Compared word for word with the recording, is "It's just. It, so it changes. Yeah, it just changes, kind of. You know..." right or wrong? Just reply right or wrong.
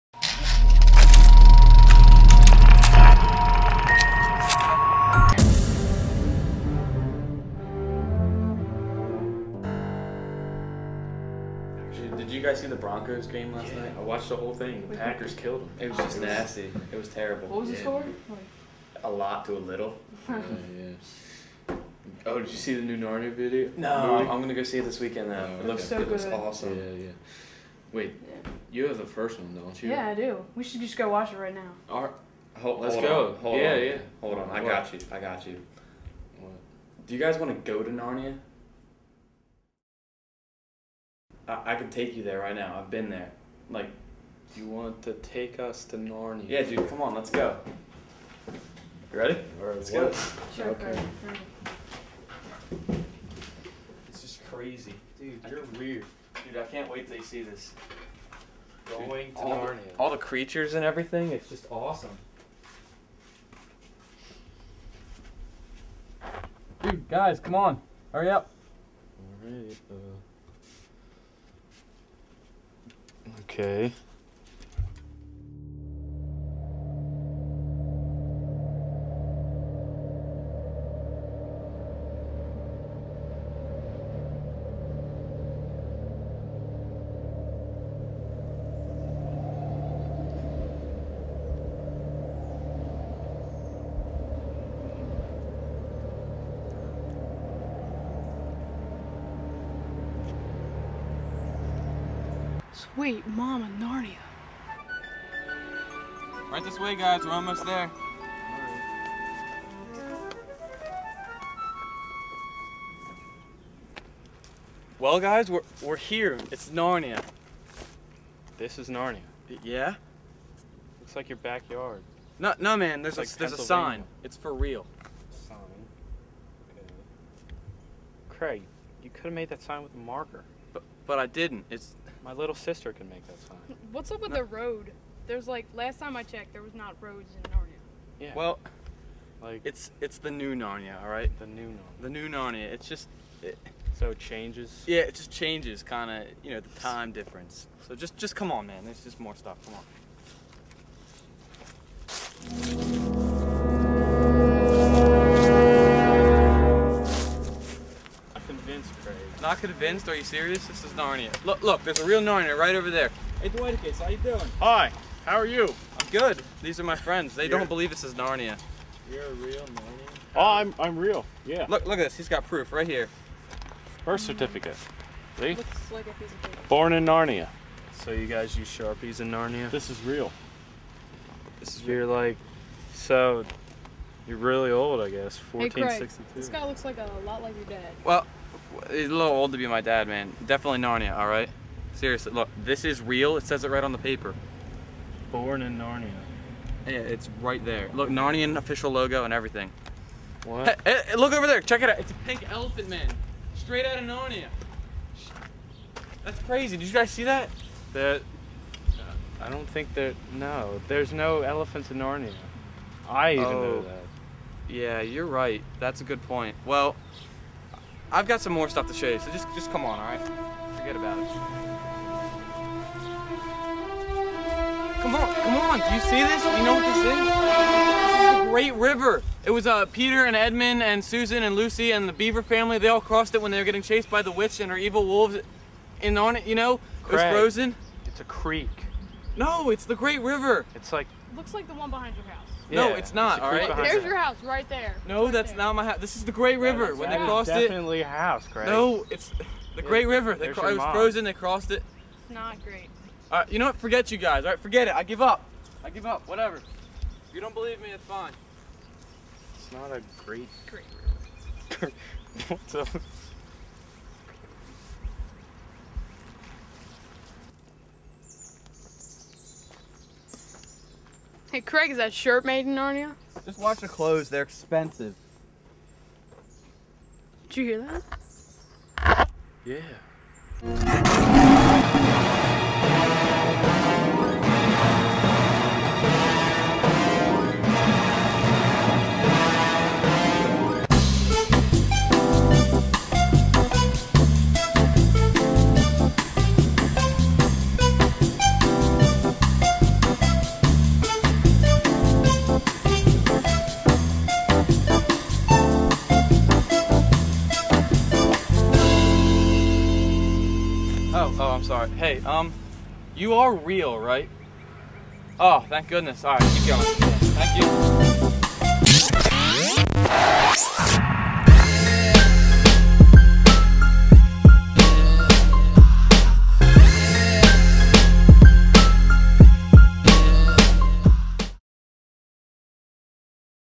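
right.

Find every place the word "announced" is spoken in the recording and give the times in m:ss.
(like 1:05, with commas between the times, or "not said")
not said.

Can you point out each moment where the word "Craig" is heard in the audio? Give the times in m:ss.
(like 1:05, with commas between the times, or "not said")
2:08, 3:57, 4:31.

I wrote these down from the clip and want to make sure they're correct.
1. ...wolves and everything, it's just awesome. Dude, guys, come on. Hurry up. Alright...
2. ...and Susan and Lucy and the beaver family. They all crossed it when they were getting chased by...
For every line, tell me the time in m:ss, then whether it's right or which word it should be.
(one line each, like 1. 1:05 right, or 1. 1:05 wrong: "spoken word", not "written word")
1. 1:00 wrong: "creatures", not "wolves"
2. 3:50 right.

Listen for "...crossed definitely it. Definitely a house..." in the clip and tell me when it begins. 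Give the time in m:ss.
4:07.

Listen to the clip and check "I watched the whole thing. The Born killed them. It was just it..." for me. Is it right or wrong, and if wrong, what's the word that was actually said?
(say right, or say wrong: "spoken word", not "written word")
wrong: "Packers", not "Born".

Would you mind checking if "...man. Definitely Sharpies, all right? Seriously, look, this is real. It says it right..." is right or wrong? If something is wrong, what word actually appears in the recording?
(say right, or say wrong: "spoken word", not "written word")
wrong: "Narnia", not "Sharpies".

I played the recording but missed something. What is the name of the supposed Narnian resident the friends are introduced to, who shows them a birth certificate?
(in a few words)
Dwighticus.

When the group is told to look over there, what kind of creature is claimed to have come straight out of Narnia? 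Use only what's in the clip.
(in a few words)
pink elephant.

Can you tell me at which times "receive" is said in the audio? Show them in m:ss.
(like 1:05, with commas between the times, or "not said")
not said.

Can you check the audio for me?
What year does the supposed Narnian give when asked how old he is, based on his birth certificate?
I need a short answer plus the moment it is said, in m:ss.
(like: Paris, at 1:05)
1462, at 3:05.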